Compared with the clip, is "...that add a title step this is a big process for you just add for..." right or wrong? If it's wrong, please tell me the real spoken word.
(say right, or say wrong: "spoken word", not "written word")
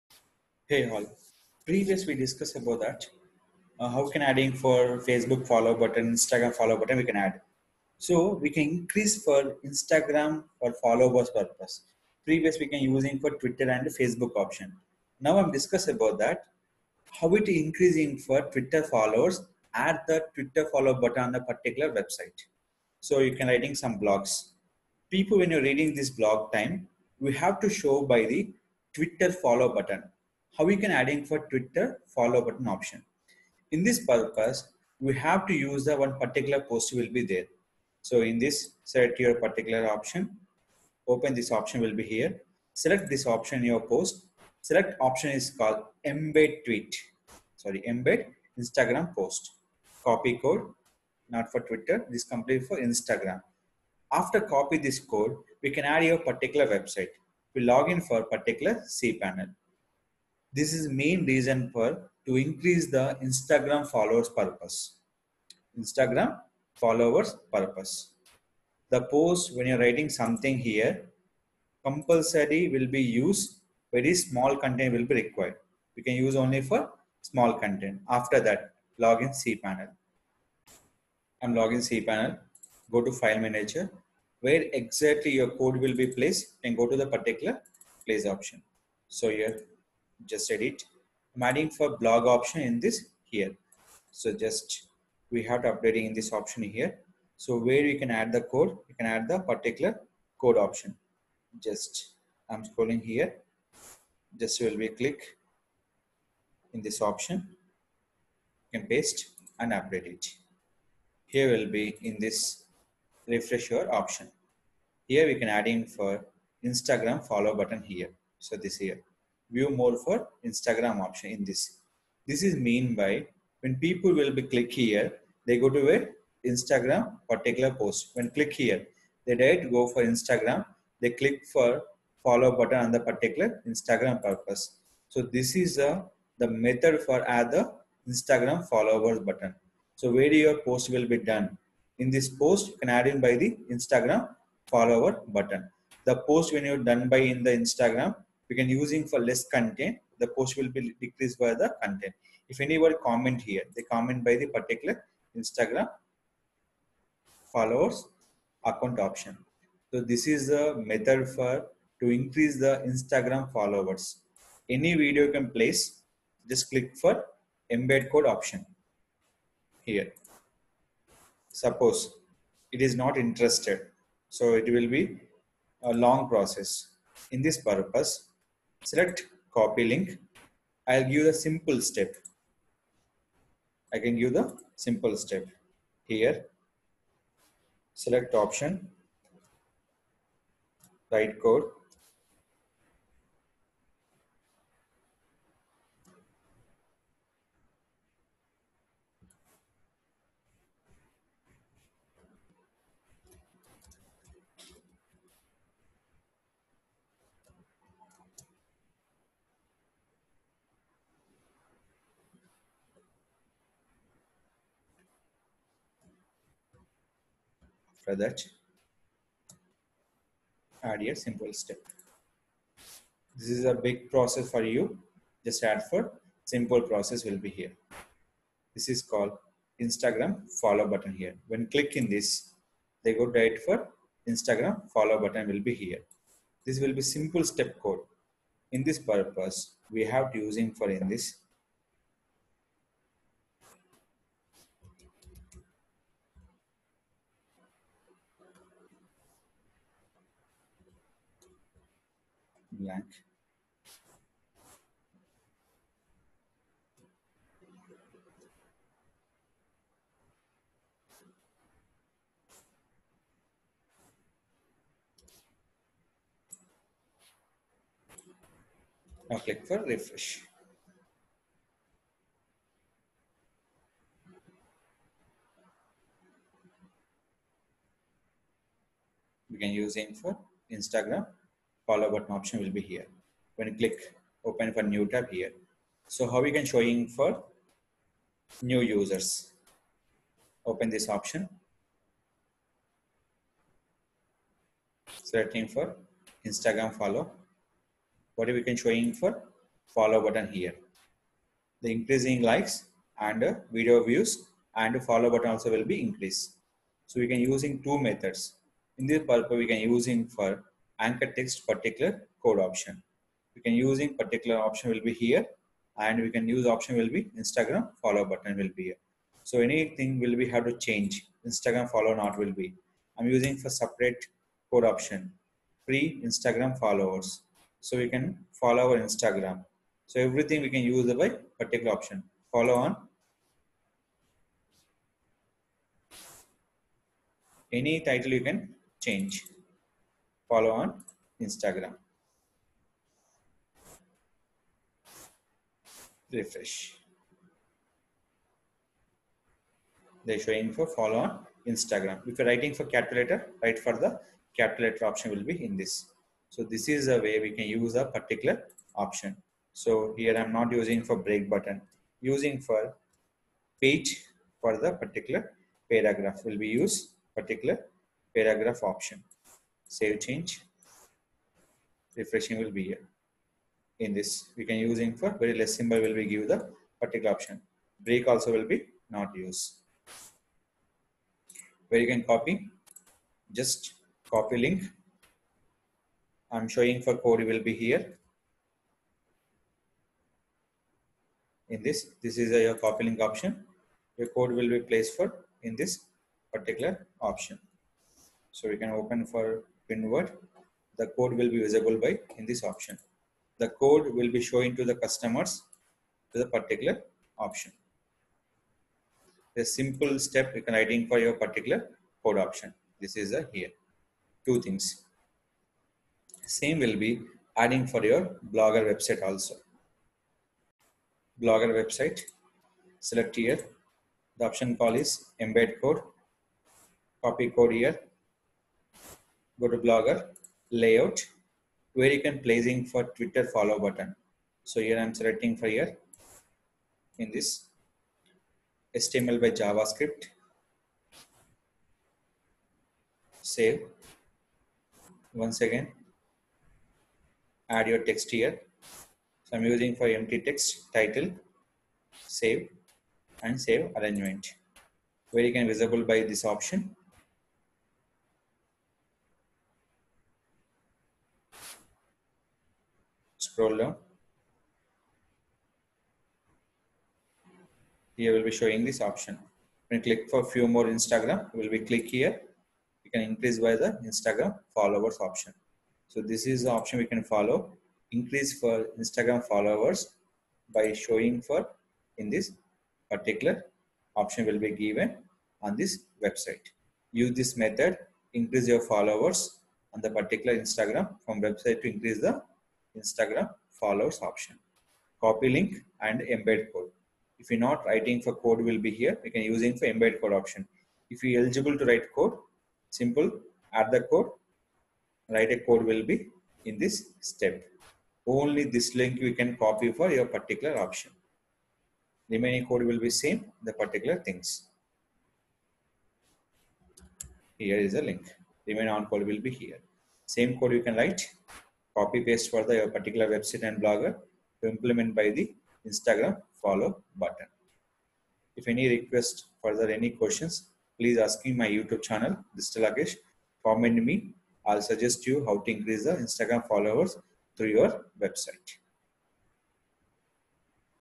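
wrong: "simple", not "title".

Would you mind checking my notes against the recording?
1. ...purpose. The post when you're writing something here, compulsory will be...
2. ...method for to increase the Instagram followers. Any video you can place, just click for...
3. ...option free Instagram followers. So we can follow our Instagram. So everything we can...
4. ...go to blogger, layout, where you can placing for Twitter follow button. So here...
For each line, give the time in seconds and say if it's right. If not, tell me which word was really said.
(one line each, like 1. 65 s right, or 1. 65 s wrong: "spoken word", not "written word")
1. 67 s right
2. 160 s right
3. 324 s right
4. 429 s right.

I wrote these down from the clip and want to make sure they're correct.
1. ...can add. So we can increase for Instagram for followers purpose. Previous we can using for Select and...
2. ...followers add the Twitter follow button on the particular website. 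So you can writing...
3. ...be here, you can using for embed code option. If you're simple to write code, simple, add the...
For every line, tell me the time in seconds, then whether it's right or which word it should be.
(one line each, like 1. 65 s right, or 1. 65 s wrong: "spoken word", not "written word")
1. 7 s wrong: "Twitter", not "Select"
2. 18 s right
3. 498 s wrong: "eligible", not "simple".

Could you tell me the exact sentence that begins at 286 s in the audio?
So how we can showing for new users.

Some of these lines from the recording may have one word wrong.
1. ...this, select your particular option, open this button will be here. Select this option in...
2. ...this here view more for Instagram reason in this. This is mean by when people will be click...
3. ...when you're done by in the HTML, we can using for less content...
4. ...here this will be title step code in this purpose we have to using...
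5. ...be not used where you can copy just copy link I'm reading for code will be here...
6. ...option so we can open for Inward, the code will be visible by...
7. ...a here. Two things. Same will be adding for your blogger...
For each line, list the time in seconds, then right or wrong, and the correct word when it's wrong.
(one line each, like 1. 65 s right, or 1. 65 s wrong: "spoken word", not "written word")
1. 38 s wrong: "option", not "button"
2. 118 s wrong: "option", not "reason"
3. 146 s wrong: "Instagram", not "HTML"
4. 235 s wrong: "simple", not "title"
5. 378 s wrong: "showing", not "reading"
6. 397 s right
7. 413 s right.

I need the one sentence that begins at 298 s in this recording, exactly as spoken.
What we can showing for follow button here.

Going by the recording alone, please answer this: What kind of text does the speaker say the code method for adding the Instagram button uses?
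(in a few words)
Anchor text.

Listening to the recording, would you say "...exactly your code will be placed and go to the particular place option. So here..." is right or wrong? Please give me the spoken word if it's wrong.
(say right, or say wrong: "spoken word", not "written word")
right.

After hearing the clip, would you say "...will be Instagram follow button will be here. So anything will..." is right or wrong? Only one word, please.
right.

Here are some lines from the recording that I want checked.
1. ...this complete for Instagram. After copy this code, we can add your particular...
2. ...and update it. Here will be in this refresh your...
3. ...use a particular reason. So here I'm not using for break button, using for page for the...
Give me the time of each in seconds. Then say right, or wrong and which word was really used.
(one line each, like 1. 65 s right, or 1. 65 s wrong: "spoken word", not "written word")
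1. 52 s right
2. 109 s right
3. 357 s wrong: "option", not "reason".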